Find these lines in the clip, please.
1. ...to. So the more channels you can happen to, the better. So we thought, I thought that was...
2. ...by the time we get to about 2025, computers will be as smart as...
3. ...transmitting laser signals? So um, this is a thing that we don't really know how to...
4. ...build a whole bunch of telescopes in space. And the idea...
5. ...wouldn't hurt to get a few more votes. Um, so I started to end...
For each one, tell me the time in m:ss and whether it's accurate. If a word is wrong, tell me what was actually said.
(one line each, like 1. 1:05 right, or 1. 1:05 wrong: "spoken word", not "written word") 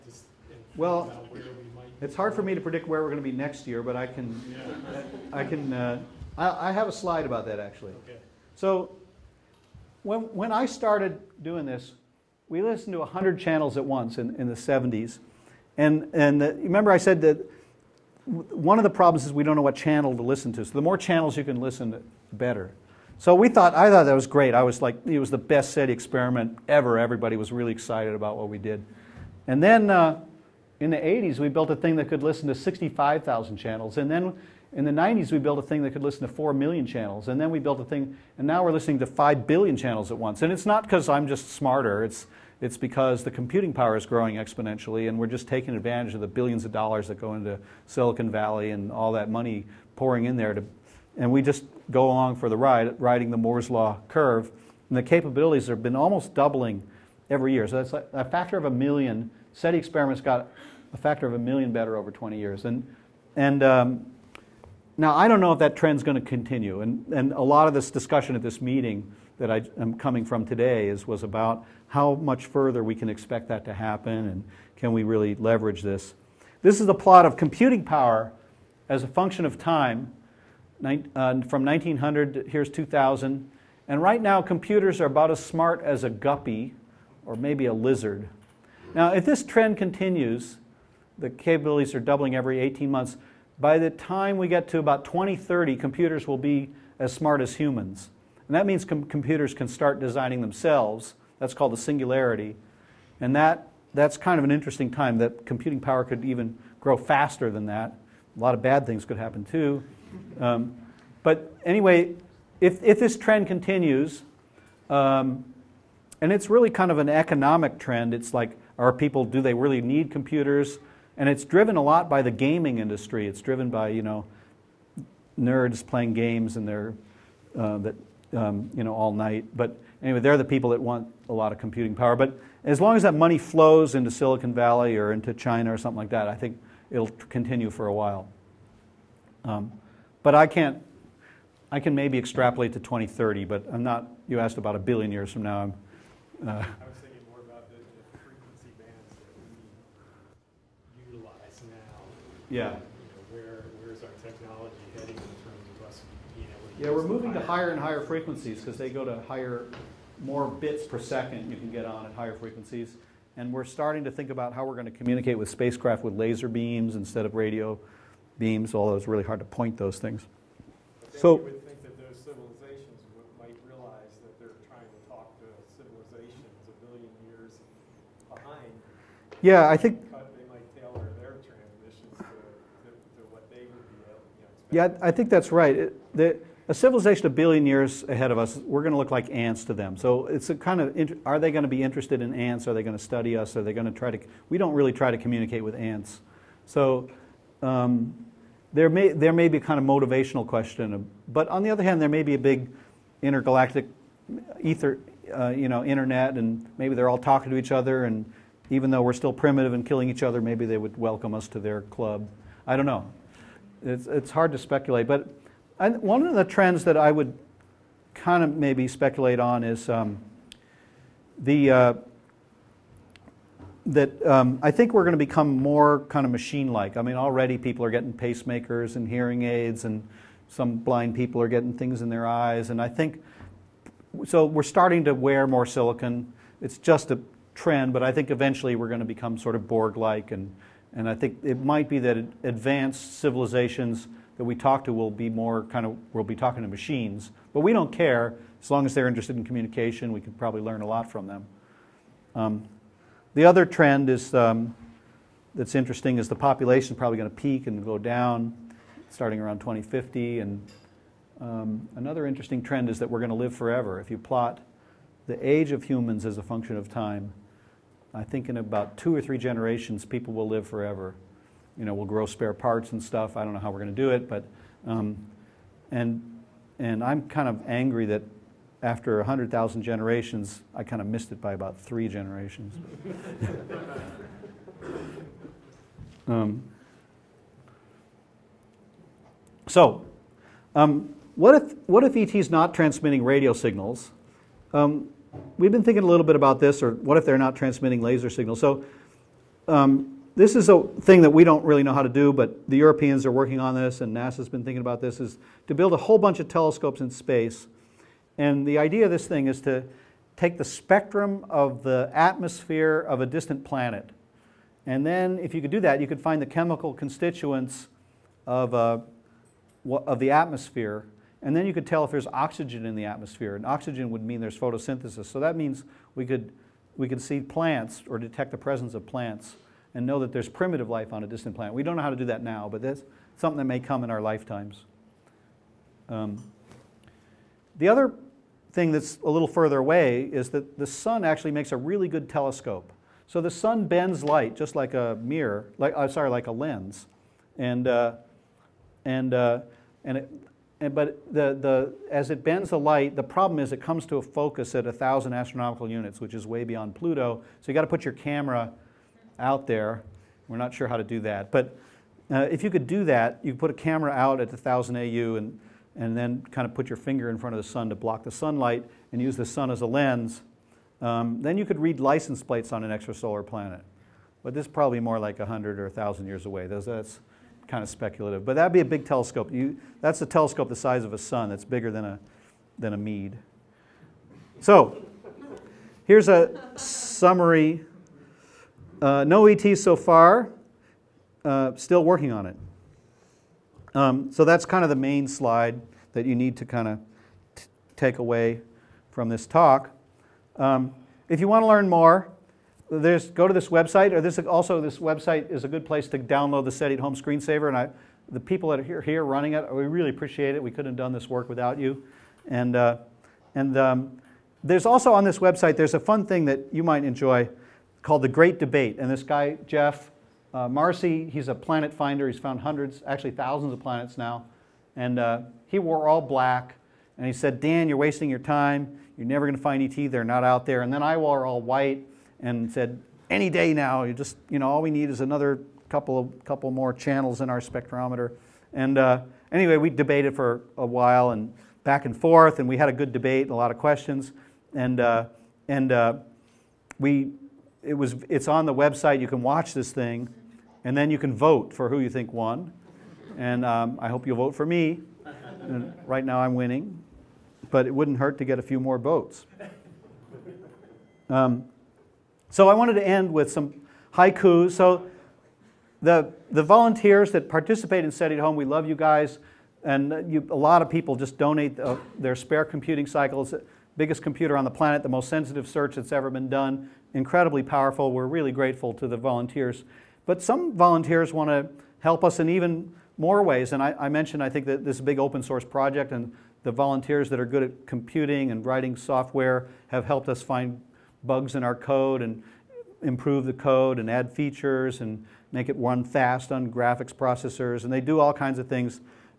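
1. 0:20 wrong: "listen", not "happen"
2. 1:33 wrong: "2030", not "2025"
3. 4:57 right
4. 5:05 right
5. 7:37 wrong: "wanted", not "started".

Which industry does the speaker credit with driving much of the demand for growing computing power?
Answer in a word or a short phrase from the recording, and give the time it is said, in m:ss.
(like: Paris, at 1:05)
gaming industry, at 2:02.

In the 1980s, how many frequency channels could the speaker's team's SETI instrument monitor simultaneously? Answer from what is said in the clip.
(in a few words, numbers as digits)
65,000.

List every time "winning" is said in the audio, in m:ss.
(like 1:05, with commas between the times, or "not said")
7:36.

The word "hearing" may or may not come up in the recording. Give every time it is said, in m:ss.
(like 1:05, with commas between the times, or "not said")
3:49.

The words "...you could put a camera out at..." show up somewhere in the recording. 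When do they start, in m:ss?
6:03.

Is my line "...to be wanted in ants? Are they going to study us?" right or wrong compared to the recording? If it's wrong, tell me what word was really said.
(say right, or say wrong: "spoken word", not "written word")
wrong: "interested", not "wanted".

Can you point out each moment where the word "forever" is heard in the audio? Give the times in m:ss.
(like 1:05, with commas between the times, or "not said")
4:23, 4:30.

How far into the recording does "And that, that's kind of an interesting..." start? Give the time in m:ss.
1:43.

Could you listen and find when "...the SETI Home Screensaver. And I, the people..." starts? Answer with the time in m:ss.
6:46.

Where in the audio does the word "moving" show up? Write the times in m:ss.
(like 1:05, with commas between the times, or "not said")
2:37.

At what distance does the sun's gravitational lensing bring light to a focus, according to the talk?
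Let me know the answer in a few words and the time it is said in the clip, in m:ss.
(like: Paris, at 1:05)
1,000 astronomical units, at 5:54.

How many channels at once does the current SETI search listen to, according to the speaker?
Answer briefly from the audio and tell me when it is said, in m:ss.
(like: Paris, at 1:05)
5 billion, at 0:39.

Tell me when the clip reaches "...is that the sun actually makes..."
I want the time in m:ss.
5:40.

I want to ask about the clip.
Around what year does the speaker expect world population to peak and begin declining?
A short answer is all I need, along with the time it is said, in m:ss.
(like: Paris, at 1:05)
2050, at 4:19.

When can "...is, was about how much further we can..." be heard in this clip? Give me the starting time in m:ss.
1:10.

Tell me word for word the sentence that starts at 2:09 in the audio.
But anyway, they're the people that want a lot of computing power.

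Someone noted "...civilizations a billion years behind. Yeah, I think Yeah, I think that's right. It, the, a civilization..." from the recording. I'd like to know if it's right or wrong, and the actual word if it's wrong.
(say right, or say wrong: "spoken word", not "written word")
right.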